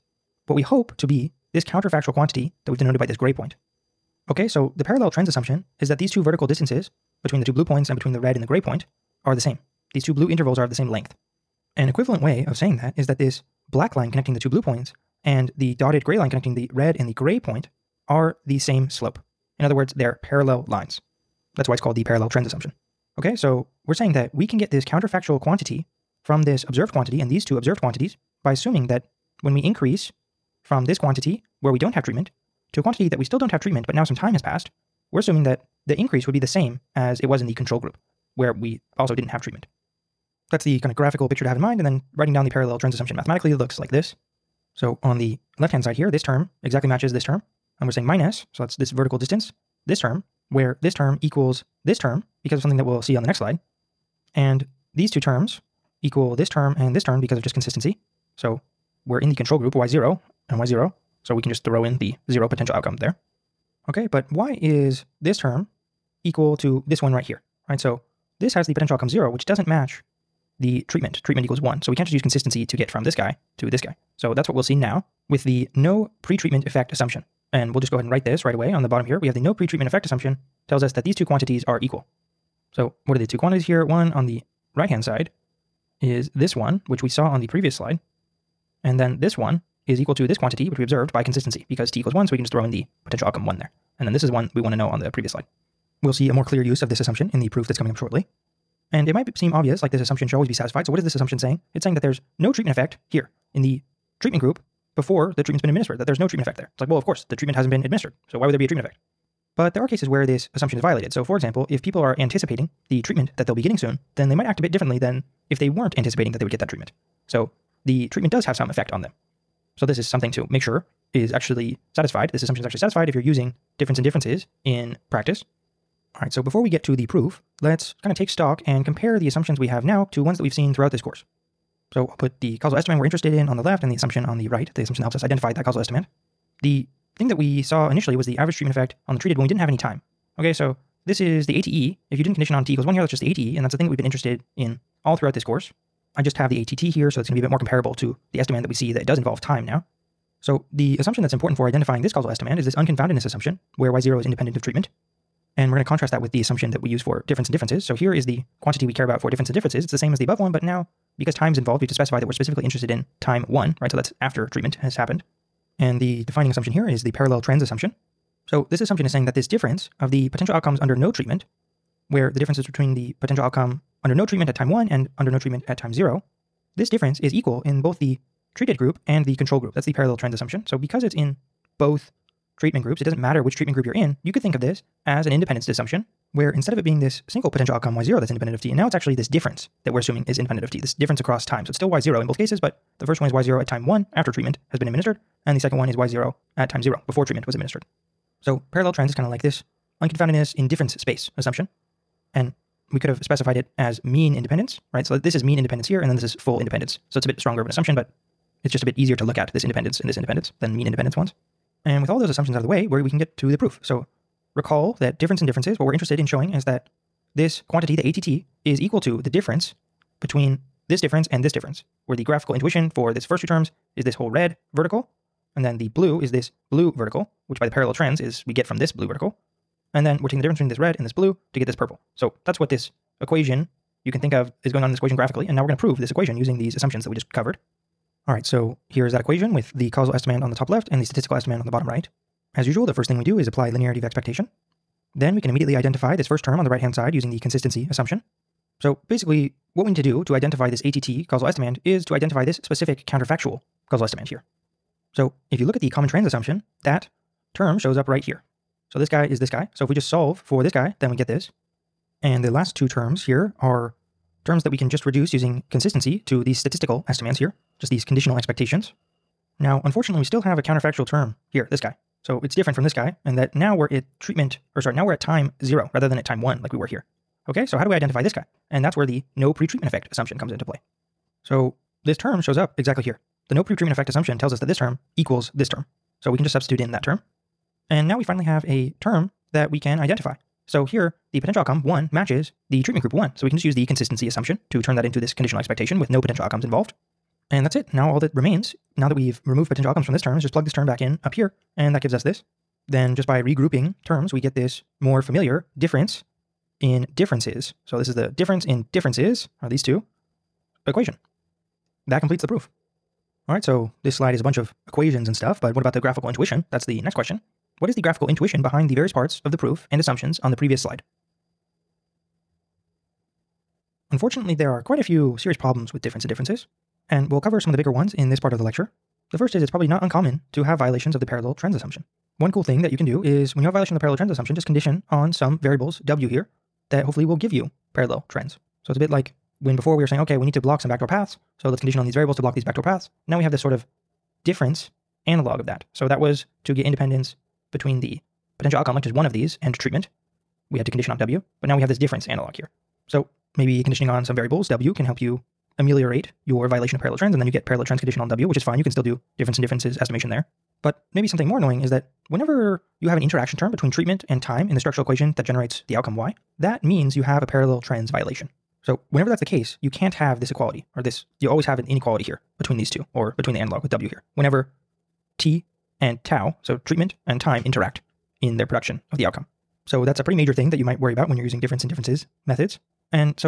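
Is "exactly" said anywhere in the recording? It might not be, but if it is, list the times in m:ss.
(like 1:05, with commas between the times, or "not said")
0:46, 4:42.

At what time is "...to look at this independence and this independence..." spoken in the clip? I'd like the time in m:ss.
3:29.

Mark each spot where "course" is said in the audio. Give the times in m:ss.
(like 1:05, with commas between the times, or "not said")
1:47, 2:11, 2:25.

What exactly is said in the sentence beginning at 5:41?
So let's condition on these variables to block these backdoor paths.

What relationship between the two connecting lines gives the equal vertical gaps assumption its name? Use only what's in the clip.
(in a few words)
Parallel lines.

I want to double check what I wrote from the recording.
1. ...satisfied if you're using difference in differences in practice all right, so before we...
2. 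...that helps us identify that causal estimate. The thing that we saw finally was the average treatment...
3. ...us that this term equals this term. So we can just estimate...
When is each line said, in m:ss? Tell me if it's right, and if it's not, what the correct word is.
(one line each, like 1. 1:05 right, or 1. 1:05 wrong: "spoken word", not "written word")
1. 2:02 right
2. 2:15 wrong: "initially", not "finally"
3. 4:44 wrong: "substitute", not "estimate".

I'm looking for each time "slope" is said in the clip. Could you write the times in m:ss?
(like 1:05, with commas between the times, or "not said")
0:18.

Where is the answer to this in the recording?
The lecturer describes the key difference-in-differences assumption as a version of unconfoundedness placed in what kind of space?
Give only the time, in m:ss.
3:20.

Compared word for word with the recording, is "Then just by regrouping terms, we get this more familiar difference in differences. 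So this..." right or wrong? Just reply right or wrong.
right.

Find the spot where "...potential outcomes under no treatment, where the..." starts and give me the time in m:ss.
2:50.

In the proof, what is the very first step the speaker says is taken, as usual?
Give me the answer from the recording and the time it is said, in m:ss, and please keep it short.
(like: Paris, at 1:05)
Linearity of expectation, at 4:03.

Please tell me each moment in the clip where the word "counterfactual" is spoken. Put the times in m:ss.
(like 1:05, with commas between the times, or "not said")
0:01, 0:24, 4:13, 4:30.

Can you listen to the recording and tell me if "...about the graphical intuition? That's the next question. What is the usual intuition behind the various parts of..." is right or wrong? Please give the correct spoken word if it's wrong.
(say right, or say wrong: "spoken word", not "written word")
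wrong: "graphical", not "usual".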